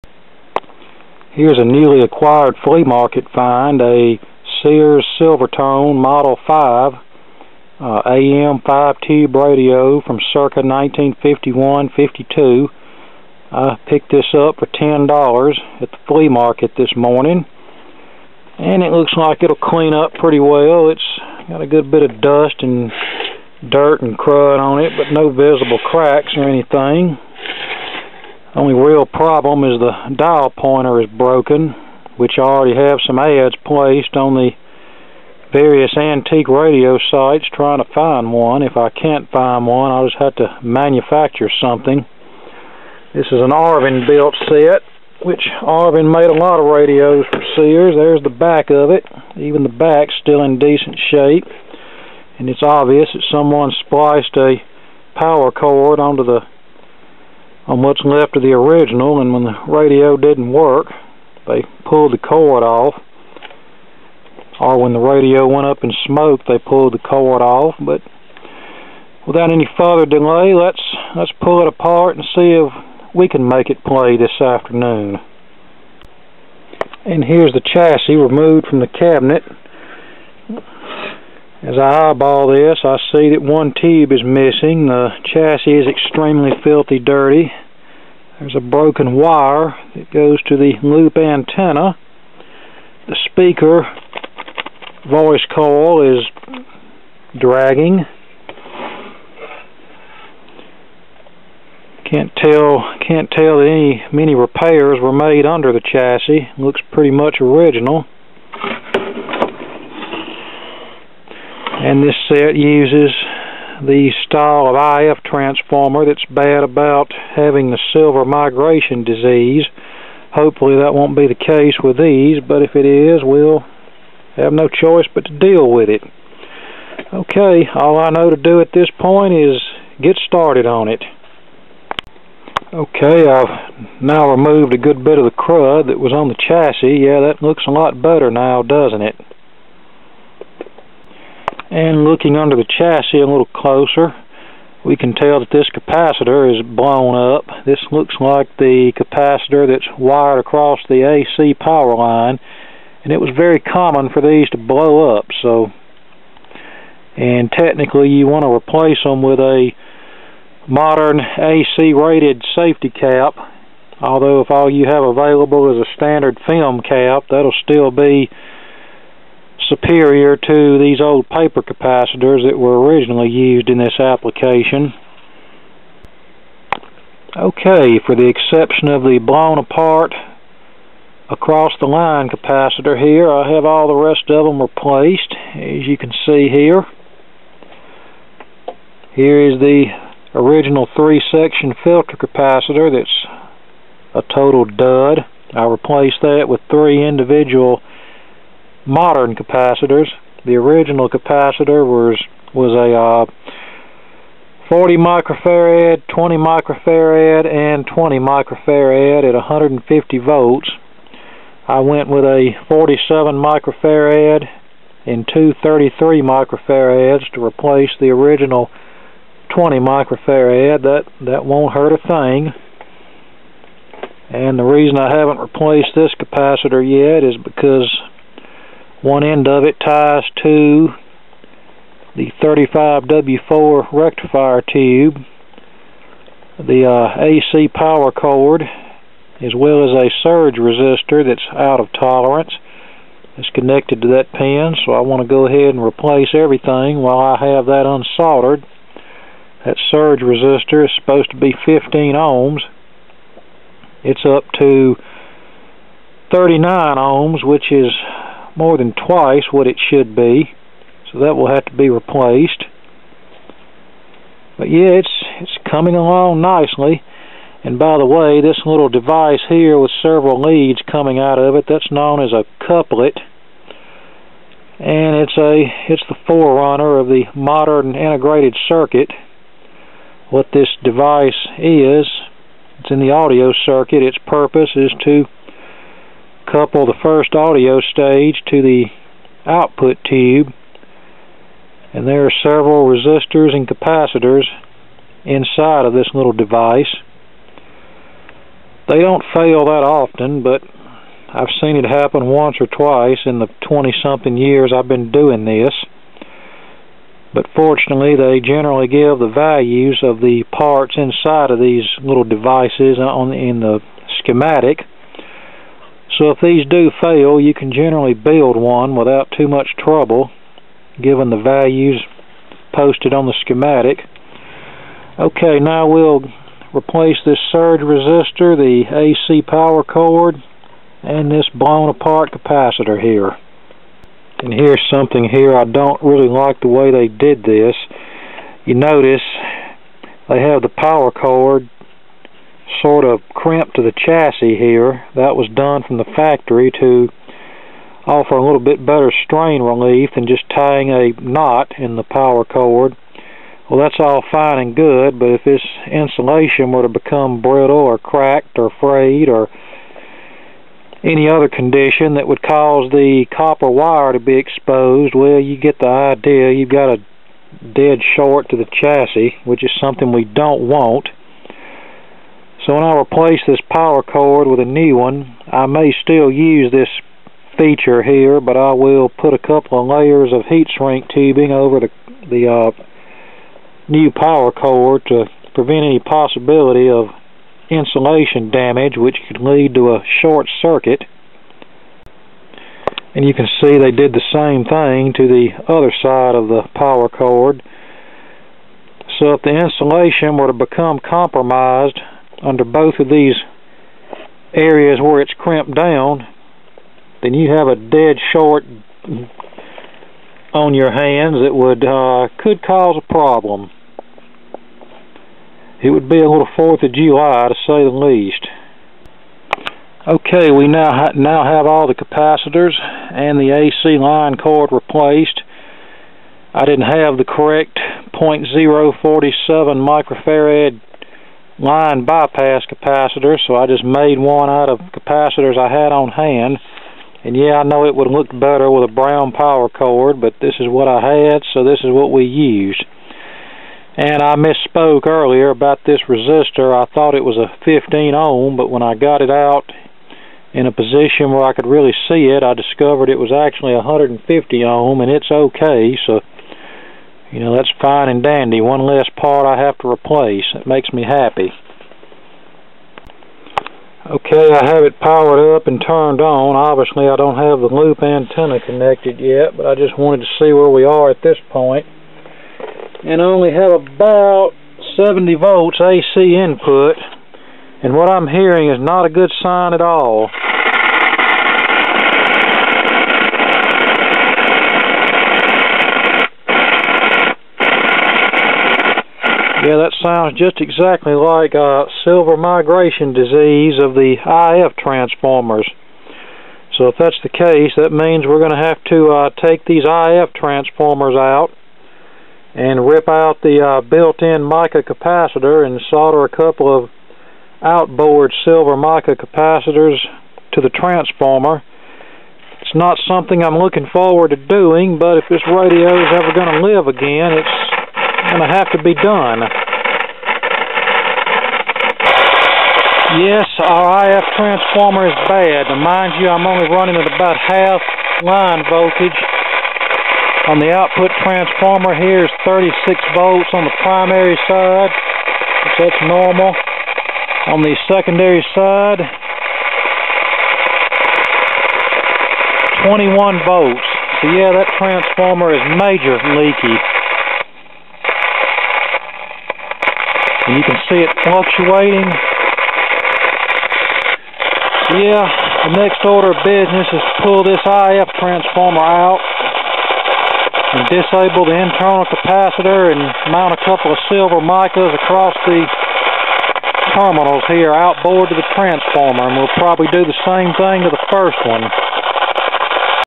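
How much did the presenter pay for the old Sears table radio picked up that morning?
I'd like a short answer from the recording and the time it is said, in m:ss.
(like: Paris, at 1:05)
$10, at 0:14.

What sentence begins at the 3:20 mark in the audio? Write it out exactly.
The original capacitor was was a uh, 40 microfarad, 20 microfarad, and 20 microfarad at 150 volts.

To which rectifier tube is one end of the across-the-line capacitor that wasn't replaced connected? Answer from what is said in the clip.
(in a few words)
35W4.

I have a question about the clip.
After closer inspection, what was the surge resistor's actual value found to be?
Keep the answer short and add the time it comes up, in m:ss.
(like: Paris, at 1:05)
150 ohm, at 7:33.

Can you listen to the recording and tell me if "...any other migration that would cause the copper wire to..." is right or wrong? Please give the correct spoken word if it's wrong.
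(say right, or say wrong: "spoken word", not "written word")
wrong: "condition", not "migration".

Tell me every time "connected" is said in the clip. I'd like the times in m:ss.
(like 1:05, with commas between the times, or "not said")
4:03, 7:48.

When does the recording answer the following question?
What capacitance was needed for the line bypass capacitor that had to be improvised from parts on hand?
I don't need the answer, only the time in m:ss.
7:08.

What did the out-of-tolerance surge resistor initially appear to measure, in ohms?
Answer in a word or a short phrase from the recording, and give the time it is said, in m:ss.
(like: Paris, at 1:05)
39 ohms, at 4:16.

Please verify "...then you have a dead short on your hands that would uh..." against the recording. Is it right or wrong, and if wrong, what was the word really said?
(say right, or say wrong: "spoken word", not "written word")
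right.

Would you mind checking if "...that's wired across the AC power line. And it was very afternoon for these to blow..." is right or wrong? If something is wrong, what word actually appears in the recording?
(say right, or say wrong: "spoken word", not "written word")
wrong: "common", not "afternoon".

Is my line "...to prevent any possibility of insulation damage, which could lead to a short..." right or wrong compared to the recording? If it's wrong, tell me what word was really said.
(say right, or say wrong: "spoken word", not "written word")
right.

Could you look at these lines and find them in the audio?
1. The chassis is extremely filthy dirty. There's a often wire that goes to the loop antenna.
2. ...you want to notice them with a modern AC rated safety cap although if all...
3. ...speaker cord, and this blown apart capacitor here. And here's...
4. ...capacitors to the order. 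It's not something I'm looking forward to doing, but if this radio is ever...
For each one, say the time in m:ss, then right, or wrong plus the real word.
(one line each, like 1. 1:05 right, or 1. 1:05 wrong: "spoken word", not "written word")
1. 1:24 wrong: "broken", not "often"
2. 2:38 wrong: "replace", not "notice"
3. 5:29 wrong: "power", not "speaker"
4. 8:29 wrong: "transformer", not "order".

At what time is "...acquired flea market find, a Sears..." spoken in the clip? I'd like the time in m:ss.
0:02.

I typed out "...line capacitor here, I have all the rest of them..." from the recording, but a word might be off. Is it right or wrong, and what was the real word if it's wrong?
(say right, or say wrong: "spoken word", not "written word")
right.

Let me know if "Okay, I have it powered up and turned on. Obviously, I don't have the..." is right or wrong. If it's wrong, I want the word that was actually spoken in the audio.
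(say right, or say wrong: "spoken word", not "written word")
right.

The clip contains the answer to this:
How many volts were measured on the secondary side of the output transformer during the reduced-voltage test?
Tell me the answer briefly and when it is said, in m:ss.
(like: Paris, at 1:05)
21 volts, at 9:02.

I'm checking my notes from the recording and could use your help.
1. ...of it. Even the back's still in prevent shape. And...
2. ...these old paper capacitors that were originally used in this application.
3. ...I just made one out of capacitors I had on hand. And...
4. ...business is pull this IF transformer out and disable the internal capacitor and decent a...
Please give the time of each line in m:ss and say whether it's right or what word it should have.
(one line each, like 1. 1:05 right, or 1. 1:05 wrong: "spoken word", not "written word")
1. 0:48 wrong: "decent", not "prevent"
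2. 2:50 right
3. 7:13 right
4. 9:16 wrong: "mount", not "decent".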